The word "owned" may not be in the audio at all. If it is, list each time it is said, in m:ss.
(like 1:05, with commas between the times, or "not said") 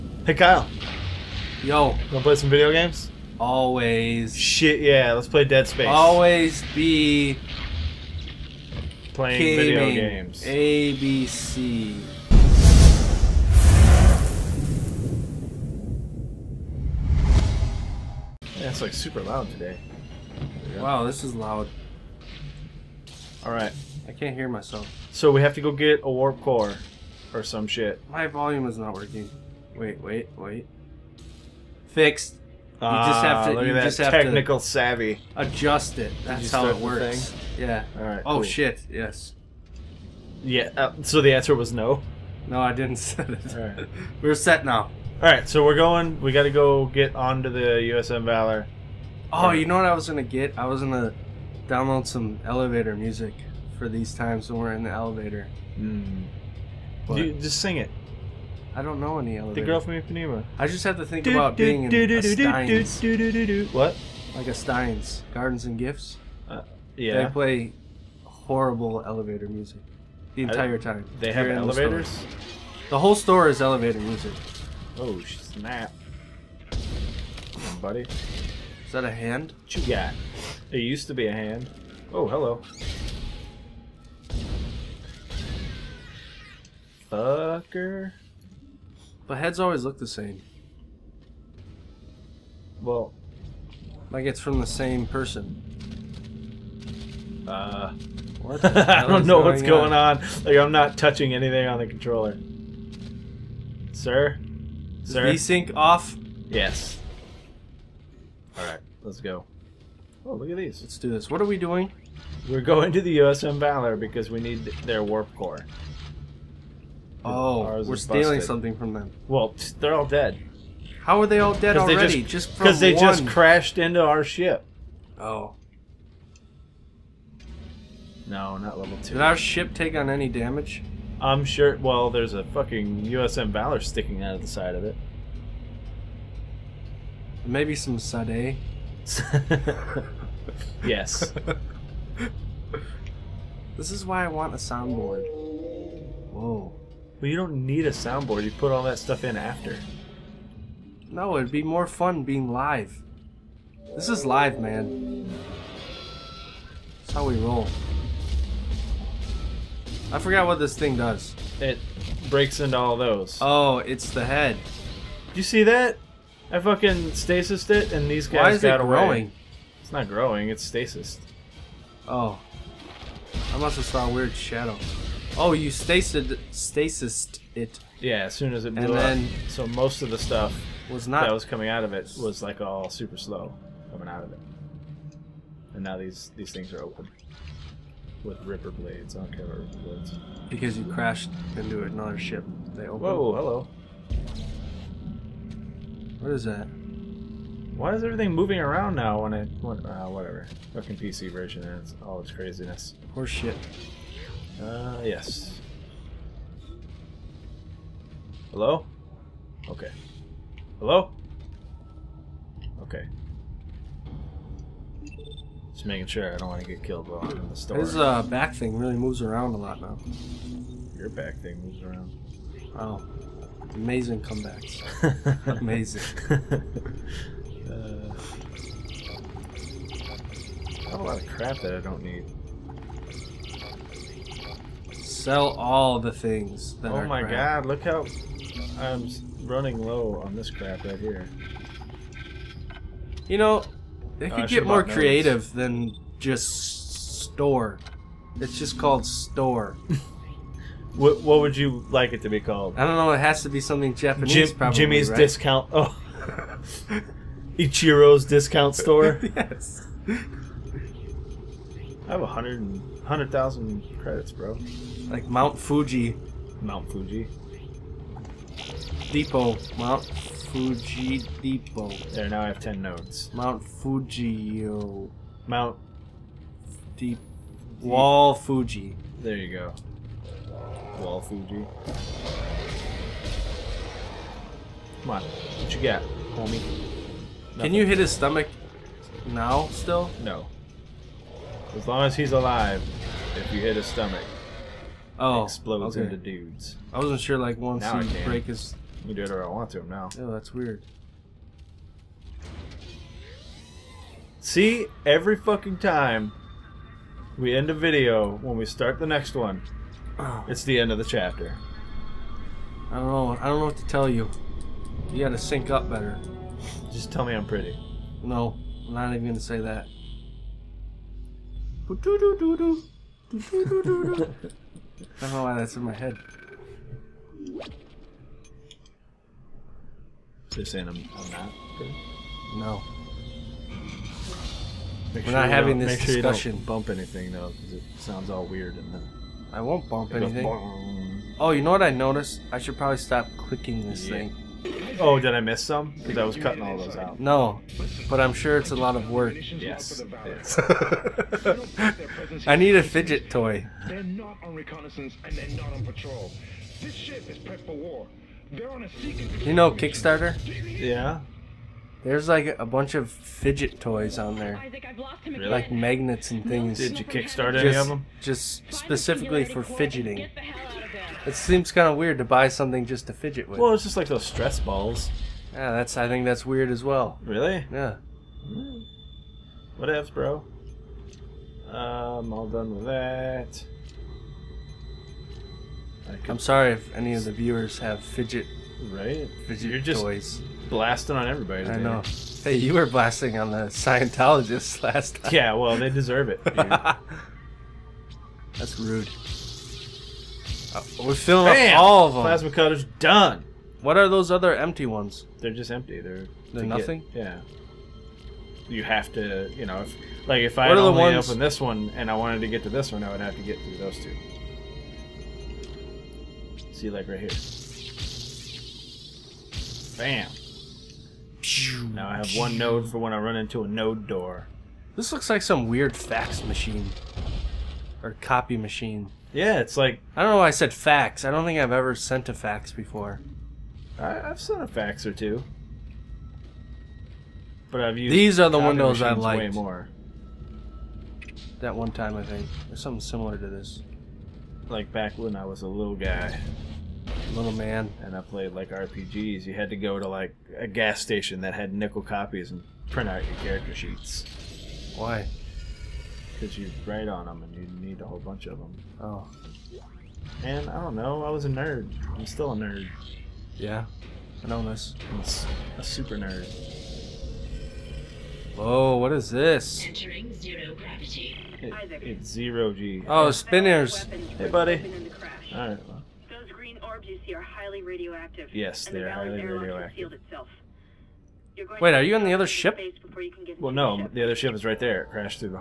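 not said.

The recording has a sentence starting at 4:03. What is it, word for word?
You know, they oh, could get more creative notes.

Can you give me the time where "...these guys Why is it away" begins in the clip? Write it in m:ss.
2:48.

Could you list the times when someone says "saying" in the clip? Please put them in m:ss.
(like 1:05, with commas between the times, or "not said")
5:30.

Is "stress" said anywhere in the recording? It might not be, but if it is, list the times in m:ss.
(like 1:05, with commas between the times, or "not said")
6:14.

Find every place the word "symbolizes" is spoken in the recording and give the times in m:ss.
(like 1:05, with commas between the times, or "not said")
not said.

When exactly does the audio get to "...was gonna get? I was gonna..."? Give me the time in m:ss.
0:49.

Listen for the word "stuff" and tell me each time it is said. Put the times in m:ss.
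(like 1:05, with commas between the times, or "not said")
2:28, 3:00.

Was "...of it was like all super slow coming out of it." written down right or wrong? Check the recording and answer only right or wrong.
right.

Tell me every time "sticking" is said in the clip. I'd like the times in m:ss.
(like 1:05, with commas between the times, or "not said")
2:13.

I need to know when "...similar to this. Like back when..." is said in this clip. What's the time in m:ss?
7:23.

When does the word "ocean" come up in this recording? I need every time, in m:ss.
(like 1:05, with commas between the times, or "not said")
not said.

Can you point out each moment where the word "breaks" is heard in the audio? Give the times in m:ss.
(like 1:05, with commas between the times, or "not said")
2:42, 4:58.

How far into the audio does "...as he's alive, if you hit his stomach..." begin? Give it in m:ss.
4:52.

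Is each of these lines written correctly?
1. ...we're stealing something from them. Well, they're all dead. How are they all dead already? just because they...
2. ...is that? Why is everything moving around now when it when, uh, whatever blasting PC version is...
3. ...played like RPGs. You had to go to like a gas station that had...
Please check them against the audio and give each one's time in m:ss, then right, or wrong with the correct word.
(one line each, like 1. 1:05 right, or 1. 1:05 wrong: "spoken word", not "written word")
1. 1:57 right
2. 3:16 wrong: "fucking", not "blasting"
3. 7:28 right.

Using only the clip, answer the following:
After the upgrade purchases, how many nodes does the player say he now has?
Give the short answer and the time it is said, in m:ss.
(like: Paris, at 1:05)
10, at 4:32.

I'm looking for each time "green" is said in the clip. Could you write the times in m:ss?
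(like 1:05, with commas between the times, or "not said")
7:56.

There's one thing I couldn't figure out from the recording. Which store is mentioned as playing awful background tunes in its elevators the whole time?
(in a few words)
Steins Gardens and Gifts.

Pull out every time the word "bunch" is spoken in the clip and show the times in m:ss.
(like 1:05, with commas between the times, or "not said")
6:02, 7:38.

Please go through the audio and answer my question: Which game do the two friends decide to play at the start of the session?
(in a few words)
Dead Space.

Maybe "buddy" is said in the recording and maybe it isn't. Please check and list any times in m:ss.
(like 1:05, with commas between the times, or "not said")
1:17, 7:54.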